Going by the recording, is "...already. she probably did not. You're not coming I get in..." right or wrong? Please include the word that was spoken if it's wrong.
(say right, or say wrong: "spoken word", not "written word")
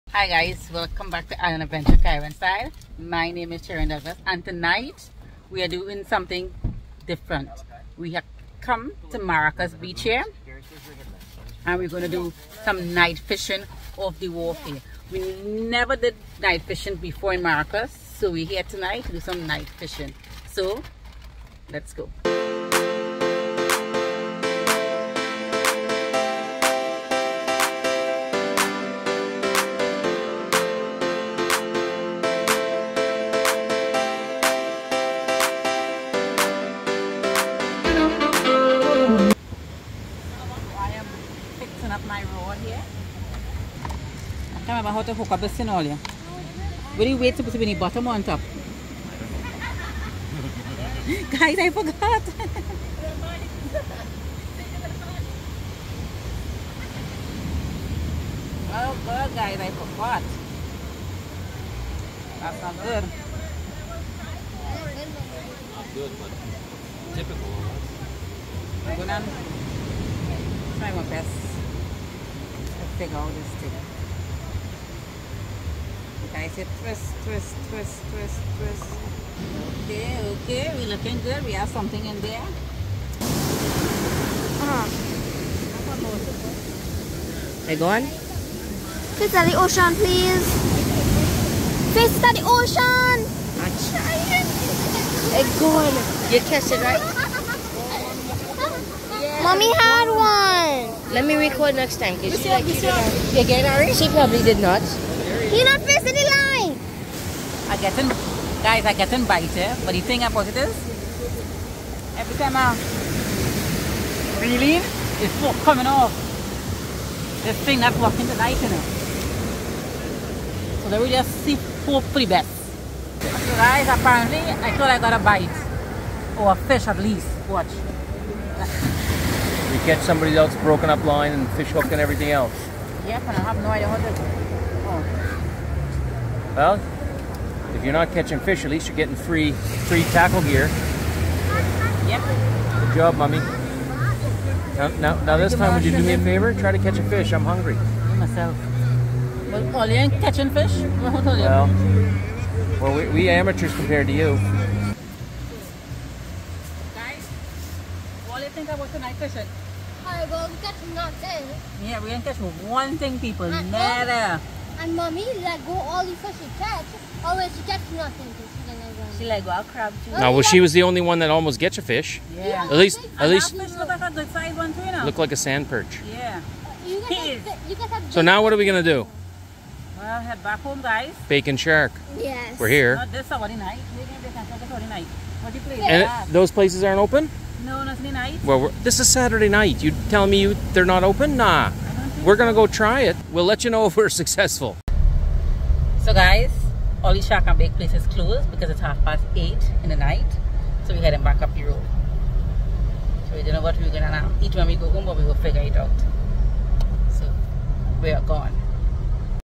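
wrong: "facing", not "coming".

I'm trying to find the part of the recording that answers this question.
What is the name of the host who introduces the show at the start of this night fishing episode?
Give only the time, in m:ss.
0:03.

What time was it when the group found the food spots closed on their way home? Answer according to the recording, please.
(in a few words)
Half past eight.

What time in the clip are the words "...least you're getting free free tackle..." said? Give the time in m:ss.
2:18.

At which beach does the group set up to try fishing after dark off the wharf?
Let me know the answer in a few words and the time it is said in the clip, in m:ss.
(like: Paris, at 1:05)
Maracas Beach, at 0:09.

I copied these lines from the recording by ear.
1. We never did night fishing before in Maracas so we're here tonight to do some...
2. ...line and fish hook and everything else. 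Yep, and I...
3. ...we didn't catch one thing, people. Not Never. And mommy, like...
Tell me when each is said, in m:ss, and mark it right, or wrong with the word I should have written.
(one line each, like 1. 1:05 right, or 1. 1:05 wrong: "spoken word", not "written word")
1. 0:15 right
2. 2:11 right
3. 2:42 right.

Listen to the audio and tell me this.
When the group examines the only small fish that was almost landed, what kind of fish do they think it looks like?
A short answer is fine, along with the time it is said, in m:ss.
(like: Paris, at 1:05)
Sand perch, at 2:55.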